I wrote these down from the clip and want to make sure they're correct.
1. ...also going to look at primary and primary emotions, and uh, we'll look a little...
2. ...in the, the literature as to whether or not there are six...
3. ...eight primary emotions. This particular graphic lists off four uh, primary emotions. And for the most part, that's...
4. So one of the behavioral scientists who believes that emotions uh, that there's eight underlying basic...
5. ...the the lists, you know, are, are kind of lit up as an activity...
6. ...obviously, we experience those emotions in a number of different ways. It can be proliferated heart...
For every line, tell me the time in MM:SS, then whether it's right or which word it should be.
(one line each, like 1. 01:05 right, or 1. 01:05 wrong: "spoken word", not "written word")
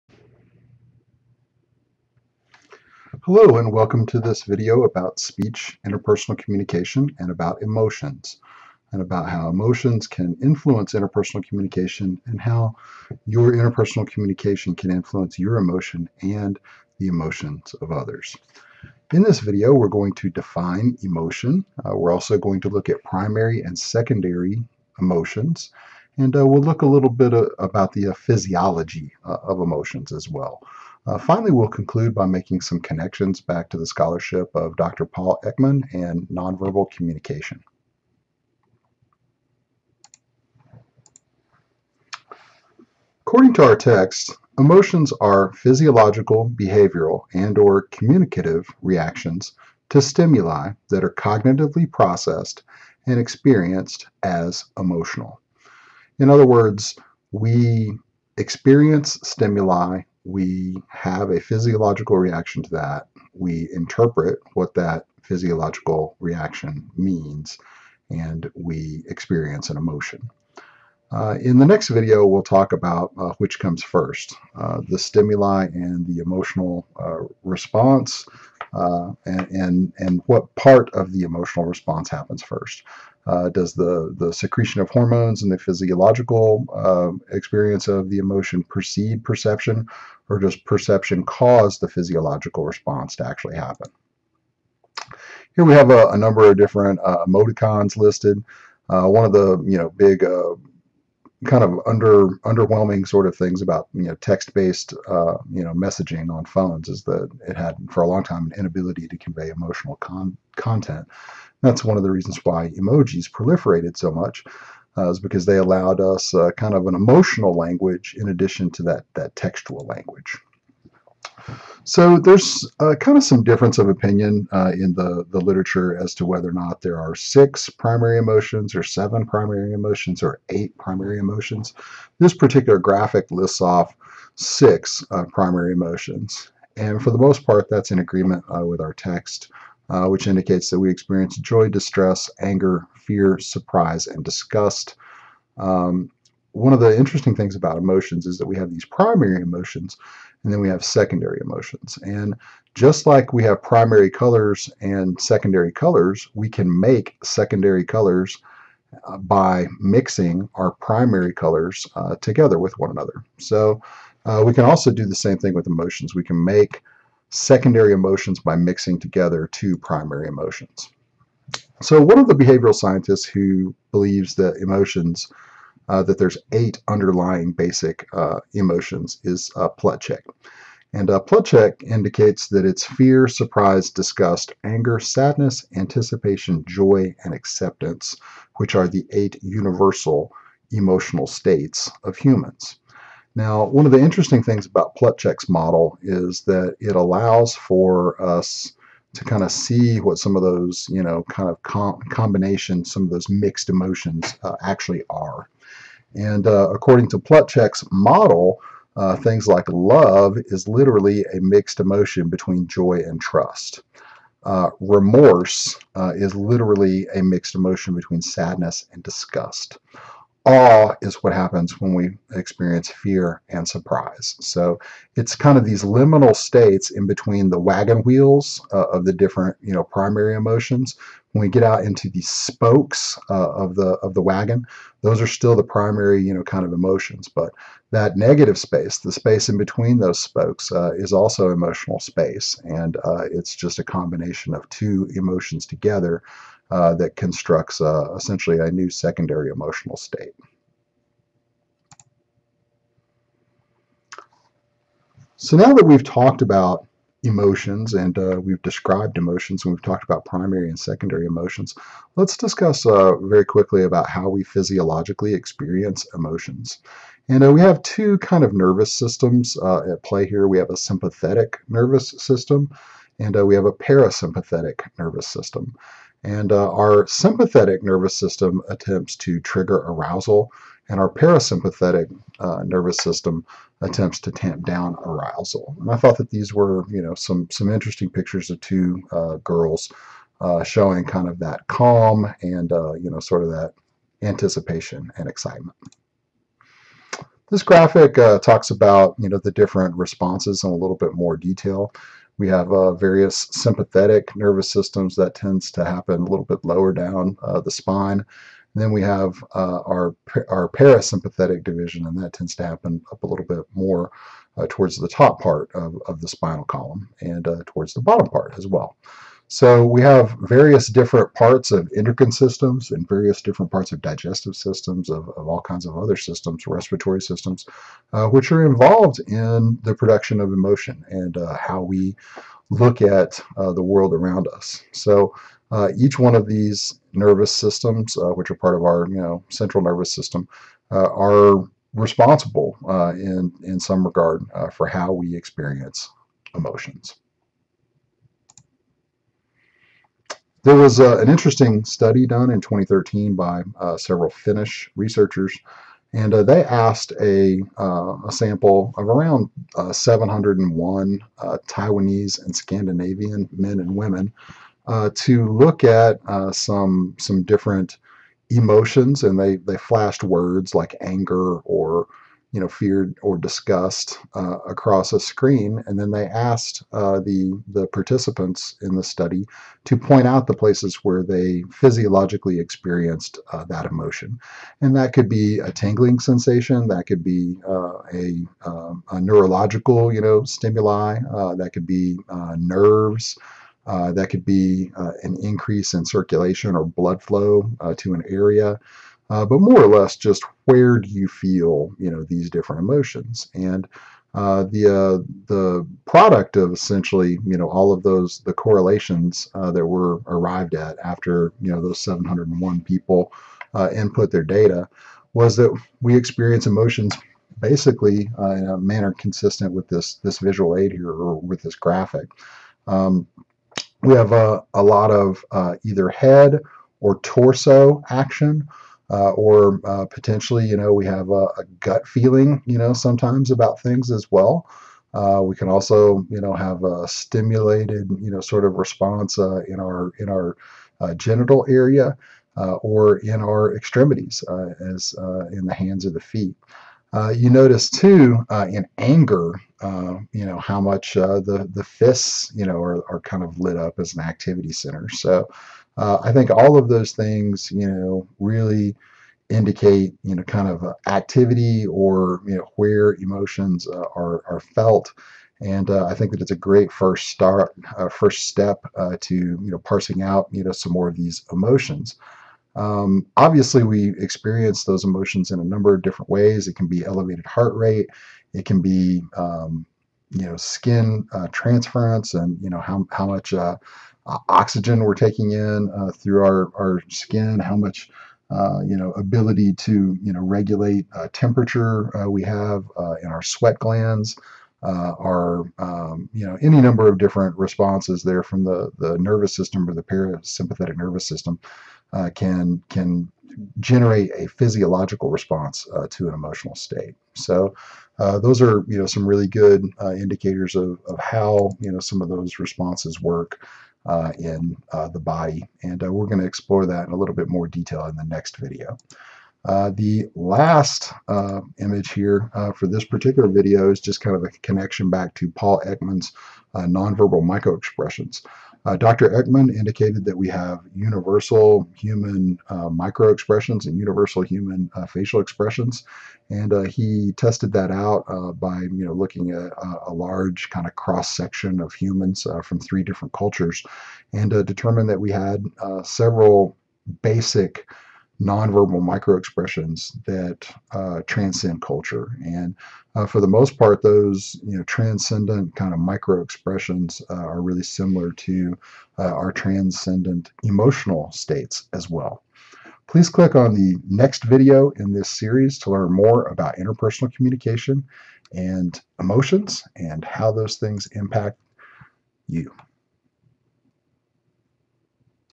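1. 00:22 wrong: "secondary", not "primary"
2. 02:04 right
3. 02:10 wrong: "six", not "four"
4. 02:51 right
5. 07:31 wrong: "fists", not "lists"
6. 07:53 wrong: "elevated", not "proliferated".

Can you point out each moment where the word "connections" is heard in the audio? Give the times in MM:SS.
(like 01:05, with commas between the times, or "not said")
00:32, 08:44.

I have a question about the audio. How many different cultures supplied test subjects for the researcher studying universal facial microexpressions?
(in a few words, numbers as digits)
3.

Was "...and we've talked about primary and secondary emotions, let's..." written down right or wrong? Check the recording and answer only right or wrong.
right.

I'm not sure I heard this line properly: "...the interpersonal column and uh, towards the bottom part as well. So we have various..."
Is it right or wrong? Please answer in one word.
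wrong.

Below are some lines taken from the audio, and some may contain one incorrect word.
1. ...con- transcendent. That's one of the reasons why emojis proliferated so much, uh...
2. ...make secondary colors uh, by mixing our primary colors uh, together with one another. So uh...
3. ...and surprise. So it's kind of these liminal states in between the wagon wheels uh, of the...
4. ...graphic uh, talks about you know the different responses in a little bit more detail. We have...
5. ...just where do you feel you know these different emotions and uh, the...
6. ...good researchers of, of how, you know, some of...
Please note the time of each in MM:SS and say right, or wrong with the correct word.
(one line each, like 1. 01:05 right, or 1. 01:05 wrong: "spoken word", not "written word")
1. 01:49 wrong: "content", not "transcendent"
2. 02:36 right
3. 03:43 right
4. 04:57 right
5. 06:40 right
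6. 08:29 wrong: "indicators", not "researchers".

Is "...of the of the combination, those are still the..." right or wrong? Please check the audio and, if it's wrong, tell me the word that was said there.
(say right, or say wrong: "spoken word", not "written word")
wrong: "wagon", not "combination".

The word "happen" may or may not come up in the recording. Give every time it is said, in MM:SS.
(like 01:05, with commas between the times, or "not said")
01:22, 01:33, 03:41, 05:05, 05:12.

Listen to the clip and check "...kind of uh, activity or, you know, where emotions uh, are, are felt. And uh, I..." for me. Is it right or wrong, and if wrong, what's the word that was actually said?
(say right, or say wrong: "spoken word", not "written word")
right.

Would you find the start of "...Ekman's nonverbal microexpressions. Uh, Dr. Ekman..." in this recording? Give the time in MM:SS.
08:45.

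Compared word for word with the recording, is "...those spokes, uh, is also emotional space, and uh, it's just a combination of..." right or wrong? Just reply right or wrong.
right.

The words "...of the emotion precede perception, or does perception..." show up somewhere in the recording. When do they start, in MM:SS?
01:27.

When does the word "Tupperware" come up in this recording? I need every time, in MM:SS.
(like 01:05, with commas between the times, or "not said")
not said.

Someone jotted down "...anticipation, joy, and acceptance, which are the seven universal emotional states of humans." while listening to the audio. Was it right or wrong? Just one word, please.
wrong.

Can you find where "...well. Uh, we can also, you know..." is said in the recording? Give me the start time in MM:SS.
07:14.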